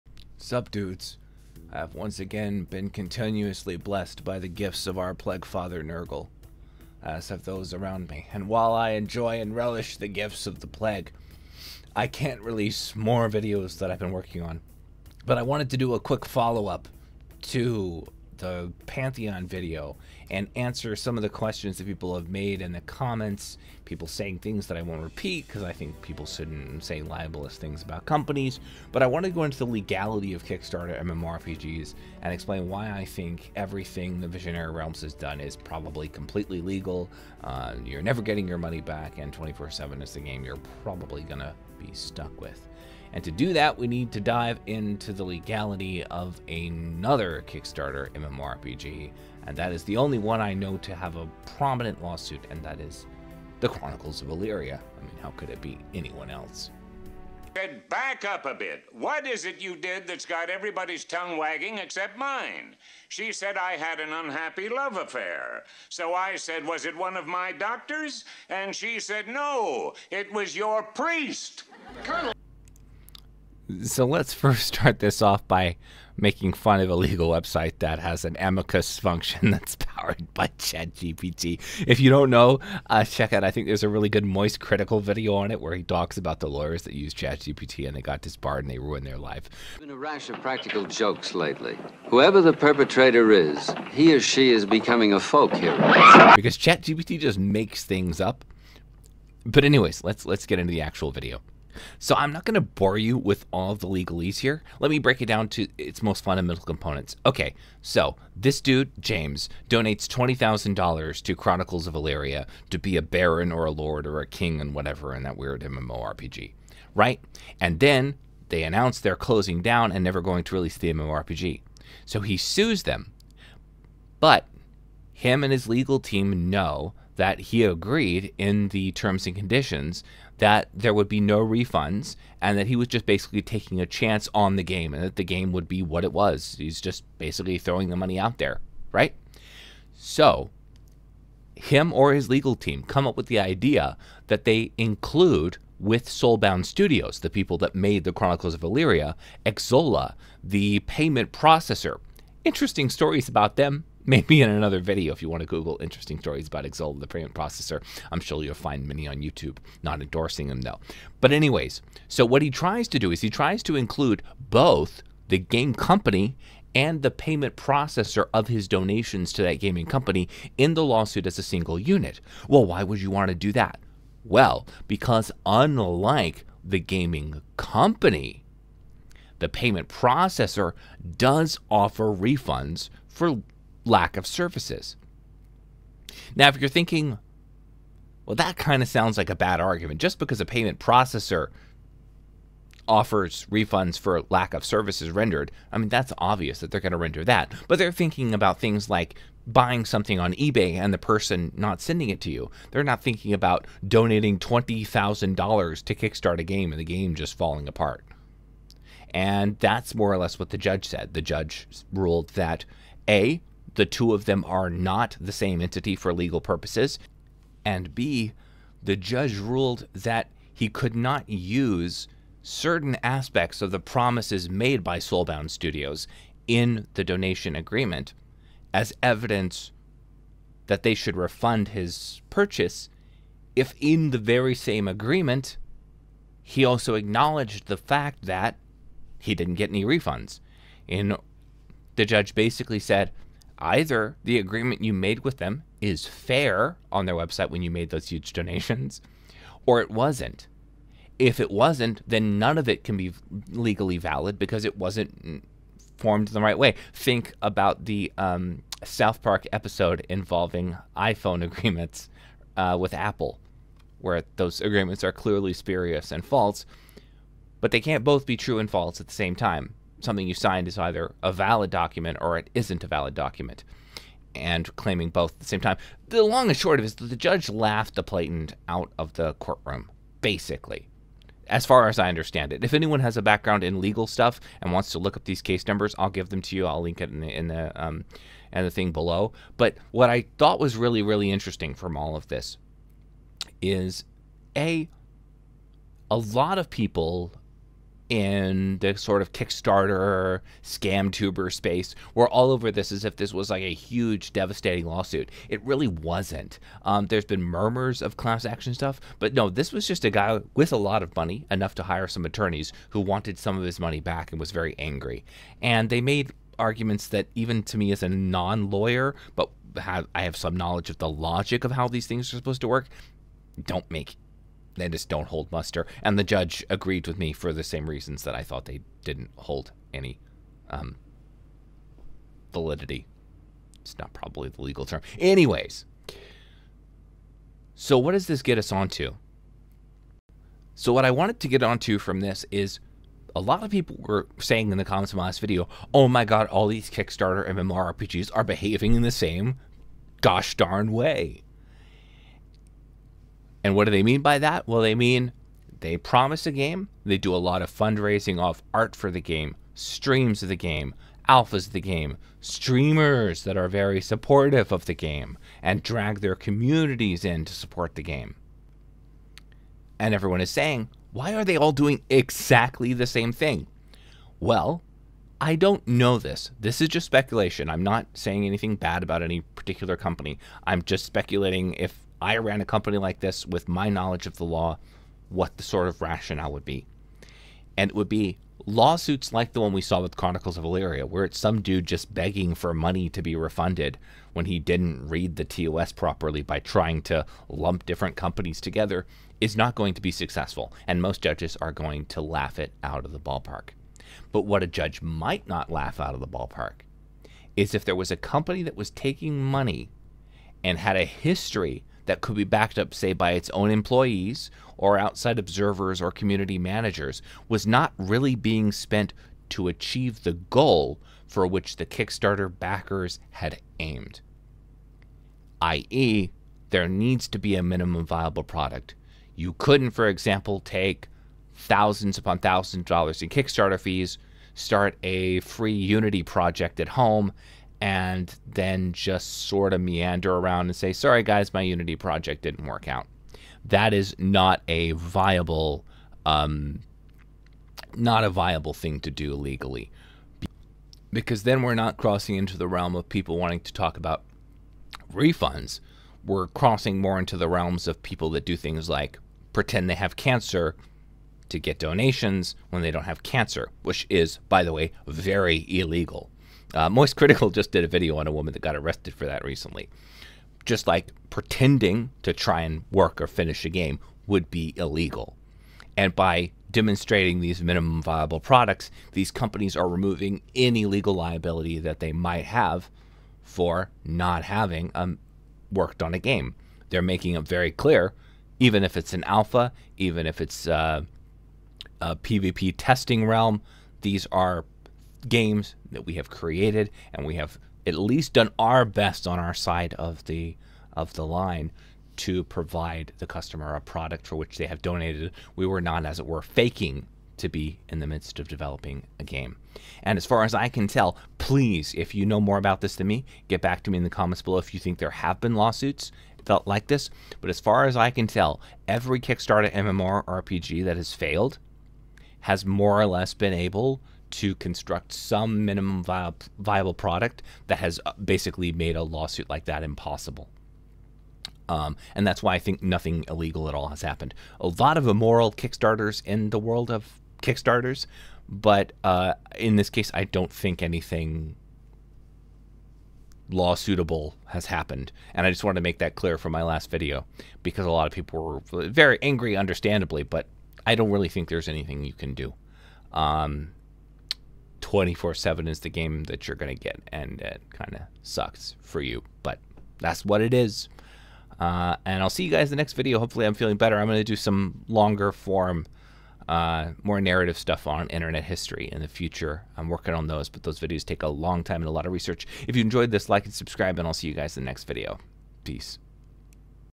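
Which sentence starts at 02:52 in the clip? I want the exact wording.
Well, why would you want to do that?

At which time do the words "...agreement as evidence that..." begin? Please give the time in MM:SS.
03:47.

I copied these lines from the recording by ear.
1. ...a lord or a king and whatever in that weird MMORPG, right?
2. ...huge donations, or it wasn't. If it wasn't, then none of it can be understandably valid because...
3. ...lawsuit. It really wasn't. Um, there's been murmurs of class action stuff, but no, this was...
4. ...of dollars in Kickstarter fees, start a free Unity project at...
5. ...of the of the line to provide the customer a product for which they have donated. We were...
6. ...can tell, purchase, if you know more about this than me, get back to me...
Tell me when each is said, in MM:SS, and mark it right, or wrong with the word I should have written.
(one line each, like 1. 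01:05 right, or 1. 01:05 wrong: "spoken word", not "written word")
1. 01:53 right
2. 04:08 wrong: "legally", not "understandably"
3. 05:04 right
4. 07:12 right
5. 08:19 right
6. 08:30 wrong: "please", not "purchase".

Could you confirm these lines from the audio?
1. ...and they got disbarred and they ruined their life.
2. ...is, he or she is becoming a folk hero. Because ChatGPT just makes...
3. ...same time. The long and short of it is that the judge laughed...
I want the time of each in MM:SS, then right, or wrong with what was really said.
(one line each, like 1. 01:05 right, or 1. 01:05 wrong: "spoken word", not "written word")
1. 01:27 right
2. 01:33 right
3. 04:35 right.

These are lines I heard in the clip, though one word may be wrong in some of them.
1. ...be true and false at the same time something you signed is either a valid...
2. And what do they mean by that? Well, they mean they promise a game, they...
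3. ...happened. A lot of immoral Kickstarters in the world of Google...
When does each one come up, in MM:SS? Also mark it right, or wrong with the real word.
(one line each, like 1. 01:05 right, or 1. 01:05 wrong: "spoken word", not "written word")
1. 04:28 right
2. 05:53 right
3. 08:54 wrong: "Kickstarters", not "Google".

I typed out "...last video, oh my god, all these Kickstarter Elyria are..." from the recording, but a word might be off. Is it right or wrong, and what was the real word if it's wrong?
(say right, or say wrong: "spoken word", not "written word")
wrong: "MMORPGs", not "Elyria".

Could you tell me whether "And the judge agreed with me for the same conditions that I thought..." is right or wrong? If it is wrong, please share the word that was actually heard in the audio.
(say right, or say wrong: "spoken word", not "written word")
wrong: "reasons", not "conditions".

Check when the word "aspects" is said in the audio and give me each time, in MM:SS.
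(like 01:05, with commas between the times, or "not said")
03:43.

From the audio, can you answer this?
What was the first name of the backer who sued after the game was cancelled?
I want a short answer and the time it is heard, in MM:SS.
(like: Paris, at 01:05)
James, at 01:48.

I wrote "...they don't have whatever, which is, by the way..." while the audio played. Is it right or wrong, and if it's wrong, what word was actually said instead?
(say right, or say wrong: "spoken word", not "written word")
wrong: "cancer", not "whatever".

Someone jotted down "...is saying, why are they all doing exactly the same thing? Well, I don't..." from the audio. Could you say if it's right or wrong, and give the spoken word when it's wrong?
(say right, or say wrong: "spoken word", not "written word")
right.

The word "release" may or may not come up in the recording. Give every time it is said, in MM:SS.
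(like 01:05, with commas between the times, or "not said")
00:12, 02:00.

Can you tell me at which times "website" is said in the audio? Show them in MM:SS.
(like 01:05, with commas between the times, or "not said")
01:17, 04:07.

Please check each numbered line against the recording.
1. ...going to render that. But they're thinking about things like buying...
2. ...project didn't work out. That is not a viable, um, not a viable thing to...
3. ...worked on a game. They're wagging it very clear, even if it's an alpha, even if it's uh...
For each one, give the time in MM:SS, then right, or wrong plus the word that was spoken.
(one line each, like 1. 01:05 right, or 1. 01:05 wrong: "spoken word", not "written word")
1. 03:16 right
2. 07:21 right
3. 08:05 wrong: "making", not "wagging".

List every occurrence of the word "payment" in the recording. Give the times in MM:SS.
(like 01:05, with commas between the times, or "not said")
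02:30, 02:37, 02:47, 02:59, 03:10.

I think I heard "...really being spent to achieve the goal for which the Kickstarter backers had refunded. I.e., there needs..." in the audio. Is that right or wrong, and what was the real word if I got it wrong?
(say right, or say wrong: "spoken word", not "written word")
wrong: "aimed", not "refunded".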